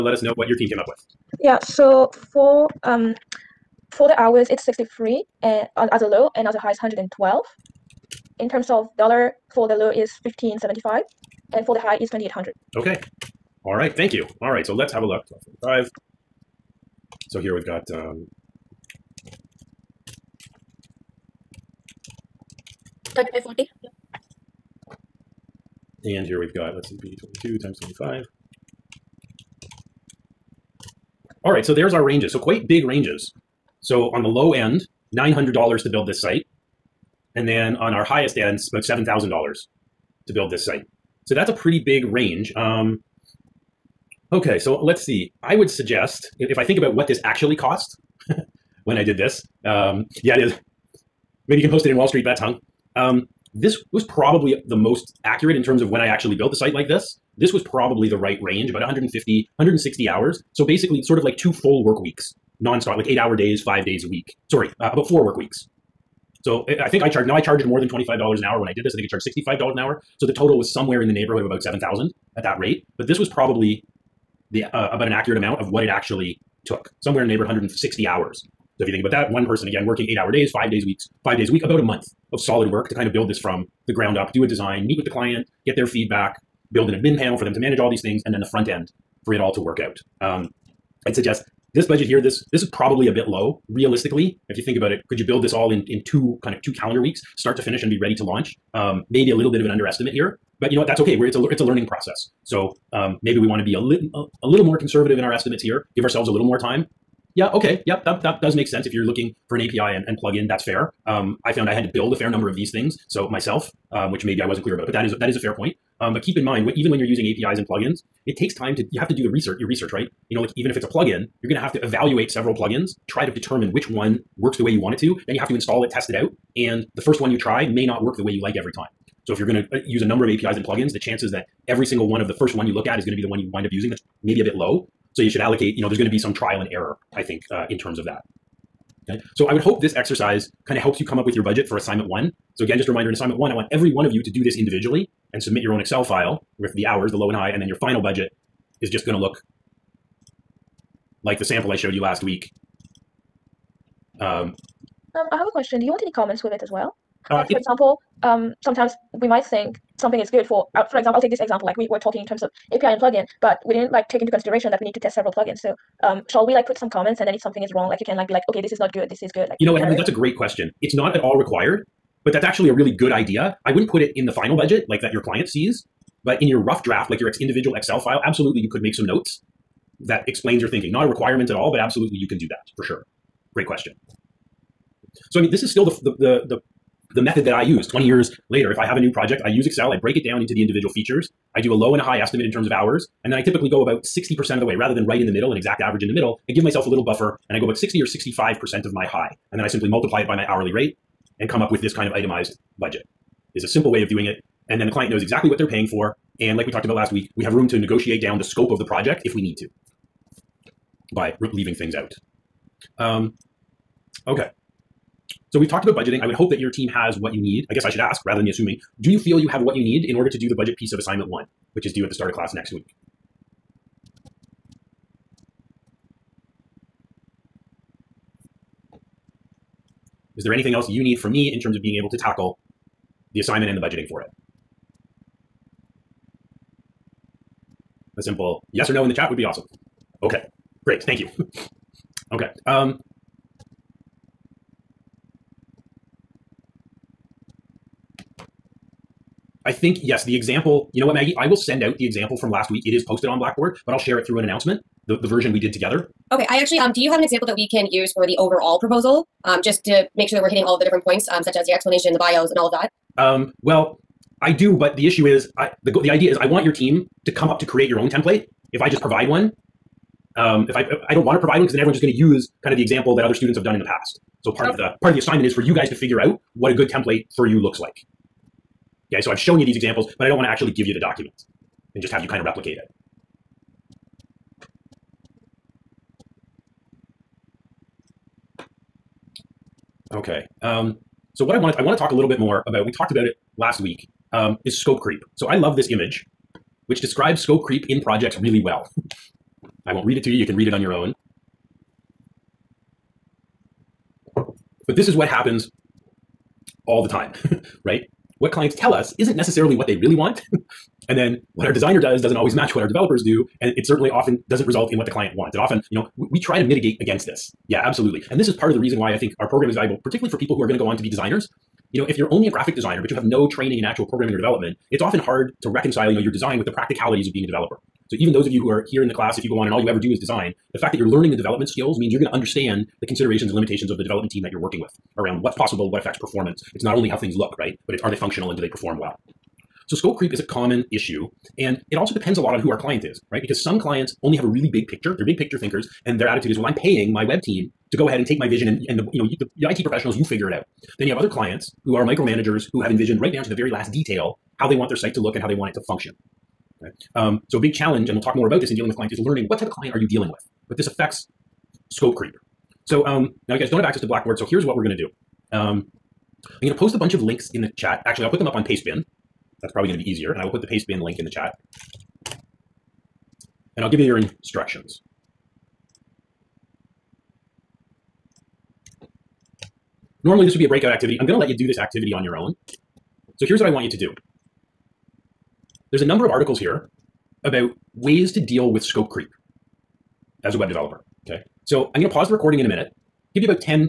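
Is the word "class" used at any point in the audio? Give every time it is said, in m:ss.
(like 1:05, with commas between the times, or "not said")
3:42, 5:29.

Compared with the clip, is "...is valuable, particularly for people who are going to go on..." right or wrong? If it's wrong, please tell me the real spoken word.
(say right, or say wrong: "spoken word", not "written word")
right.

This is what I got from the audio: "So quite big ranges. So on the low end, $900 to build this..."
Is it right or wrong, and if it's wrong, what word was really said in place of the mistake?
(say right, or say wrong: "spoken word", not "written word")
right.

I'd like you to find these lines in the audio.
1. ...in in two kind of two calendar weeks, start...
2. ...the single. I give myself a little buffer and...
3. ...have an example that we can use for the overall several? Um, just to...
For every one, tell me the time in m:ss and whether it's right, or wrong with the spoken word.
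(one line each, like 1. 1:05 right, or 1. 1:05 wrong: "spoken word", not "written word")
1. 1:35 right
2. 3:16 wrong: "middle", not "single"
3. 4:17 wrong: "proposal", not "several".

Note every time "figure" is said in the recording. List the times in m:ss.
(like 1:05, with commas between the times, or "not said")
4:35, 5:50.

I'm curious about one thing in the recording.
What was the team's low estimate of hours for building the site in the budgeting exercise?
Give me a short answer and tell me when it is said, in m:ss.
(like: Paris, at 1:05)
63, at 0:04.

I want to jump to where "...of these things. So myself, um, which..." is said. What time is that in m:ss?
1:52.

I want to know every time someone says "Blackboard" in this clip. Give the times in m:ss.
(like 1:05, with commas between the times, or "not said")
4:13, 6:04.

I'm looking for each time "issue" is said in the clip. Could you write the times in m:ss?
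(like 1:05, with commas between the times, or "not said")
4:25, 5:40.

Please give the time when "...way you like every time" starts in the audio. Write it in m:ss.
2:08.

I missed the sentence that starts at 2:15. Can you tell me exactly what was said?
So you should allocate, you know, there's going to be some trial and error, I think, uh, in terms of that.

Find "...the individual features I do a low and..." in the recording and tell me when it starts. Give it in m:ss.
3:10.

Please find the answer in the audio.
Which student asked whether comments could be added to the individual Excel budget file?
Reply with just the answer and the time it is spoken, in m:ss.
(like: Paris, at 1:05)
Emily, at 2:49.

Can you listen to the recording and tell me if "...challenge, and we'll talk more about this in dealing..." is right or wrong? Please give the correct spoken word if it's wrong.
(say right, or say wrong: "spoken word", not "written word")
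right.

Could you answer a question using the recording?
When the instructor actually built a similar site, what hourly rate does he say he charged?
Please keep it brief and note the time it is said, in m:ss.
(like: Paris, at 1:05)
$65 an hour, at 1:09.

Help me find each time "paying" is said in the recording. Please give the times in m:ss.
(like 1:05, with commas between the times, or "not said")
3:25, 5:46.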